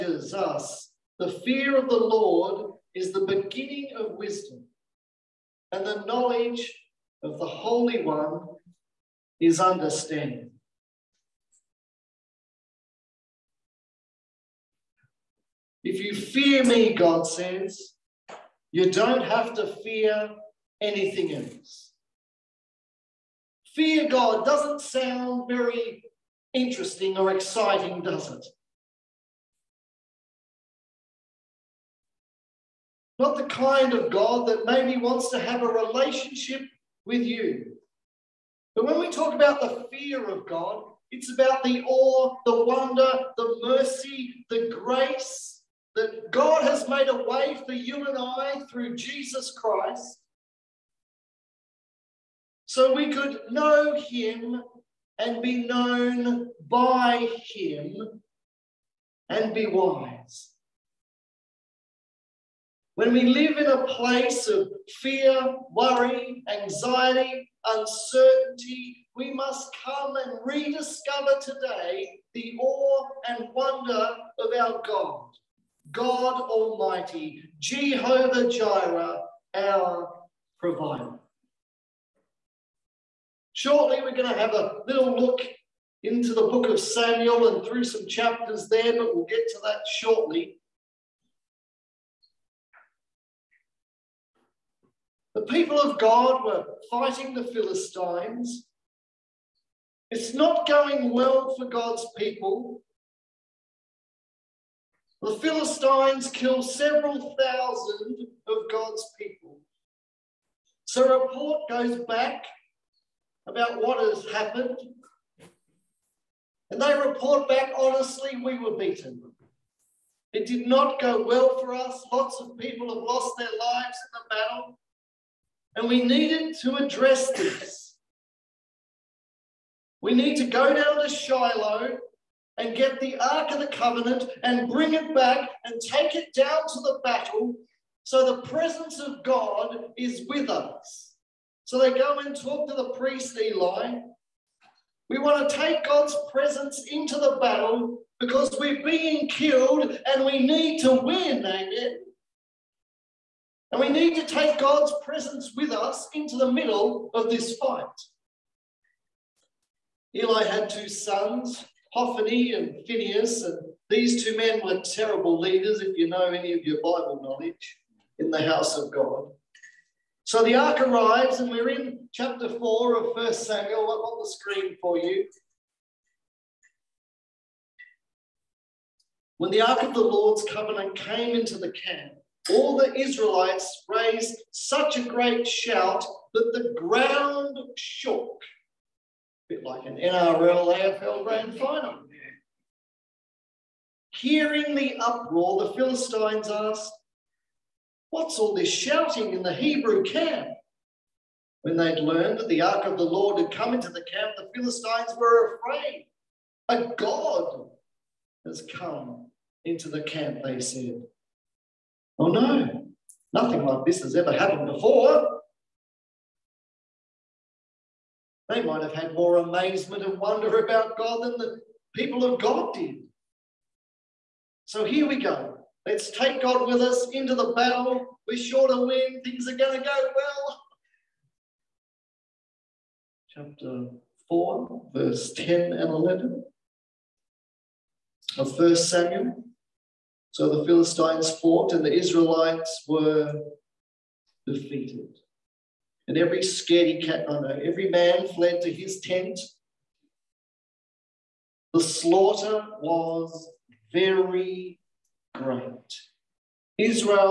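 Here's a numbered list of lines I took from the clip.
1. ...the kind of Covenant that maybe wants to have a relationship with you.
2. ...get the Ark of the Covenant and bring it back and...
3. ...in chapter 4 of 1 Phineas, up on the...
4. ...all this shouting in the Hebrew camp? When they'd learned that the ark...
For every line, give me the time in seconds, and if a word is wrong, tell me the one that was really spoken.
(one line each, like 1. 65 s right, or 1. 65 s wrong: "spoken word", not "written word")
1. 33 s wrong: "God", not "Covenant"
2. 132 s right
3. 171 s wrong: "Samuel", not "Phineas"
4. 198 s right.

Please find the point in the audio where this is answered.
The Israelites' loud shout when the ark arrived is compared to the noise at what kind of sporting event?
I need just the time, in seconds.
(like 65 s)
189 s.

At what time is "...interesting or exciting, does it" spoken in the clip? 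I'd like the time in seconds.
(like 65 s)
26 s.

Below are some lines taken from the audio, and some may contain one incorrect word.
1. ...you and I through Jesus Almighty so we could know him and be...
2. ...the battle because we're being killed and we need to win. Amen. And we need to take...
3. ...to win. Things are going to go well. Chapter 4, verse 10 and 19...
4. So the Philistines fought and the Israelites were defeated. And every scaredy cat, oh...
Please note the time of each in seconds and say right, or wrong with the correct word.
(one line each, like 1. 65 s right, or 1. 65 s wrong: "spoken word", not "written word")
1. 47 s wrong: "Christ", not "Almighty"
2. 147 s right
3. 228 s wrong: "11", not "19"
4. 240 s right.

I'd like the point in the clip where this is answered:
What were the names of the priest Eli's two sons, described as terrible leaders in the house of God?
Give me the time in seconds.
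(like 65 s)
161 s.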